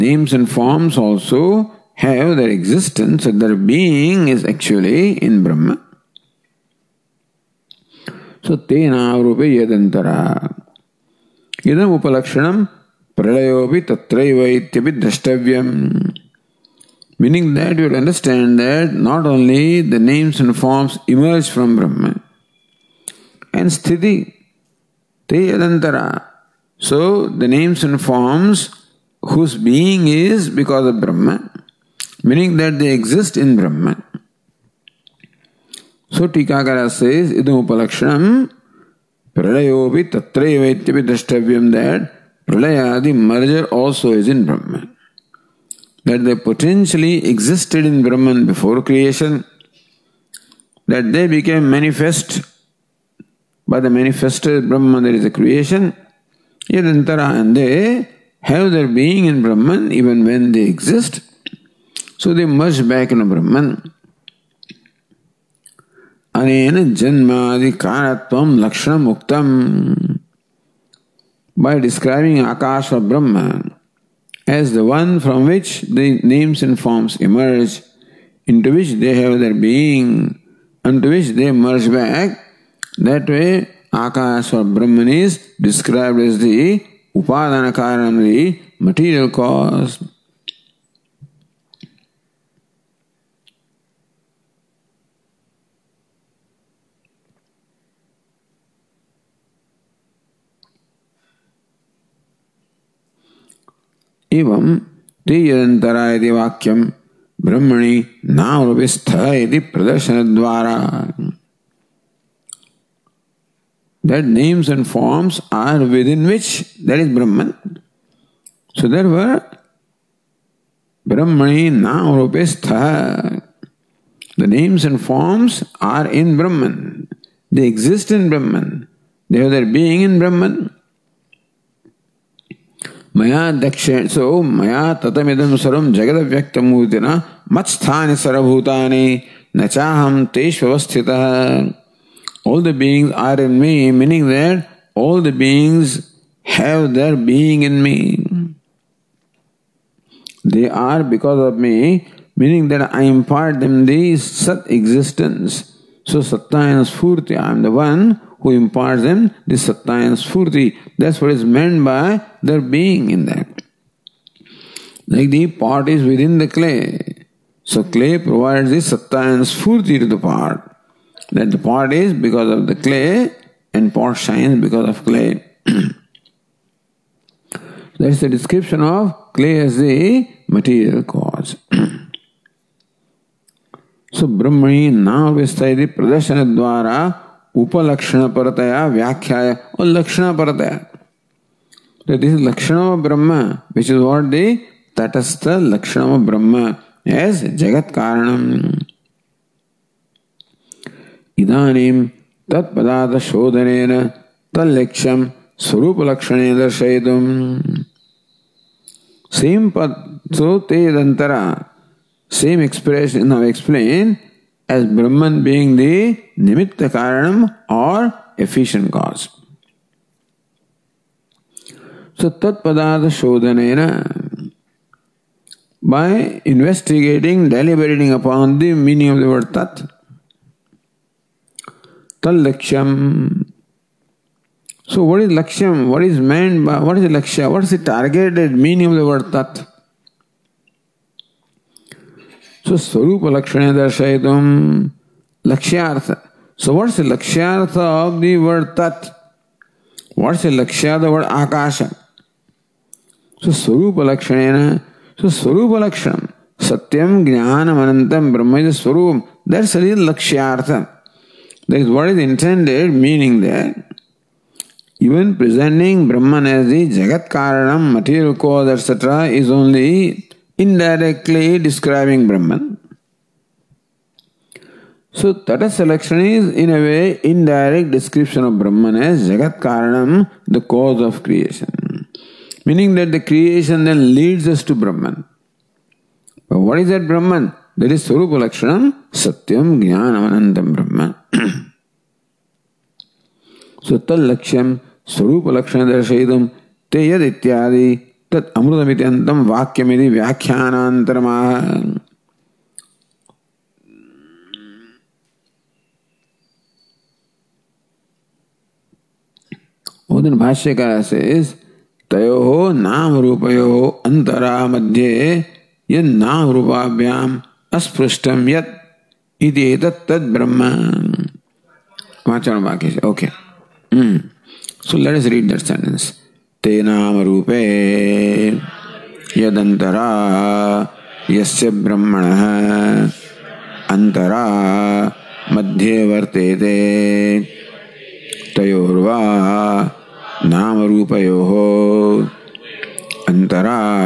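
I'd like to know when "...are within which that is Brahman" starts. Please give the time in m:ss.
1:55.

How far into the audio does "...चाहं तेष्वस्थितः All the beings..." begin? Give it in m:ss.
2:19.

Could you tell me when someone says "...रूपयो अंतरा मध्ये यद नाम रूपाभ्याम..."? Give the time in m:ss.
5:13.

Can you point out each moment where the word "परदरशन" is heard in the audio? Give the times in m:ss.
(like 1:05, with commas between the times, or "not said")
1:49, 3:05.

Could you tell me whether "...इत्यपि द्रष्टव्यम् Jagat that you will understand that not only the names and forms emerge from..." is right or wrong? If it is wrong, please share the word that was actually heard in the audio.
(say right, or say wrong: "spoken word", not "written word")
wrong: "Meaning", not "Jagat".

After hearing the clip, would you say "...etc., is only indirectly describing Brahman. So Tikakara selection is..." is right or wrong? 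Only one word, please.
wrong.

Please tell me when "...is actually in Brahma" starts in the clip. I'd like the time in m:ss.
0:04.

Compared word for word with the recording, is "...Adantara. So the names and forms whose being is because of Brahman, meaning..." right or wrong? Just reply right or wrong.
right.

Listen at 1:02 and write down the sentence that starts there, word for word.
So they merge back in Brahman.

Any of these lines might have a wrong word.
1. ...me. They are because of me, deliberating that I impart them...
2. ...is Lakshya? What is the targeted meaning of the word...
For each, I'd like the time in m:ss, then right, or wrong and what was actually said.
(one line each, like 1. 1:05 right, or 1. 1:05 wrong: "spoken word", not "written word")
1. 2:27 wrong: "meaning", not "deliberating"
2. 3:56 right.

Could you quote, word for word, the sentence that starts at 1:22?
That way, Akash or Brahman is described as the Upadana Karanam, the material cause.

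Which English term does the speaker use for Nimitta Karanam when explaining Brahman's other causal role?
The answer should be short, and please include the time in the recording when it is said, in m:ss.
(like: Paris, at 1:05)
efficient cause, at 3:38.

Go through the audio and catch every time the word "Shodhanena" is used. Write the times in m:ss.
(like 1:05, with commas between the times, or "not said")
3:43.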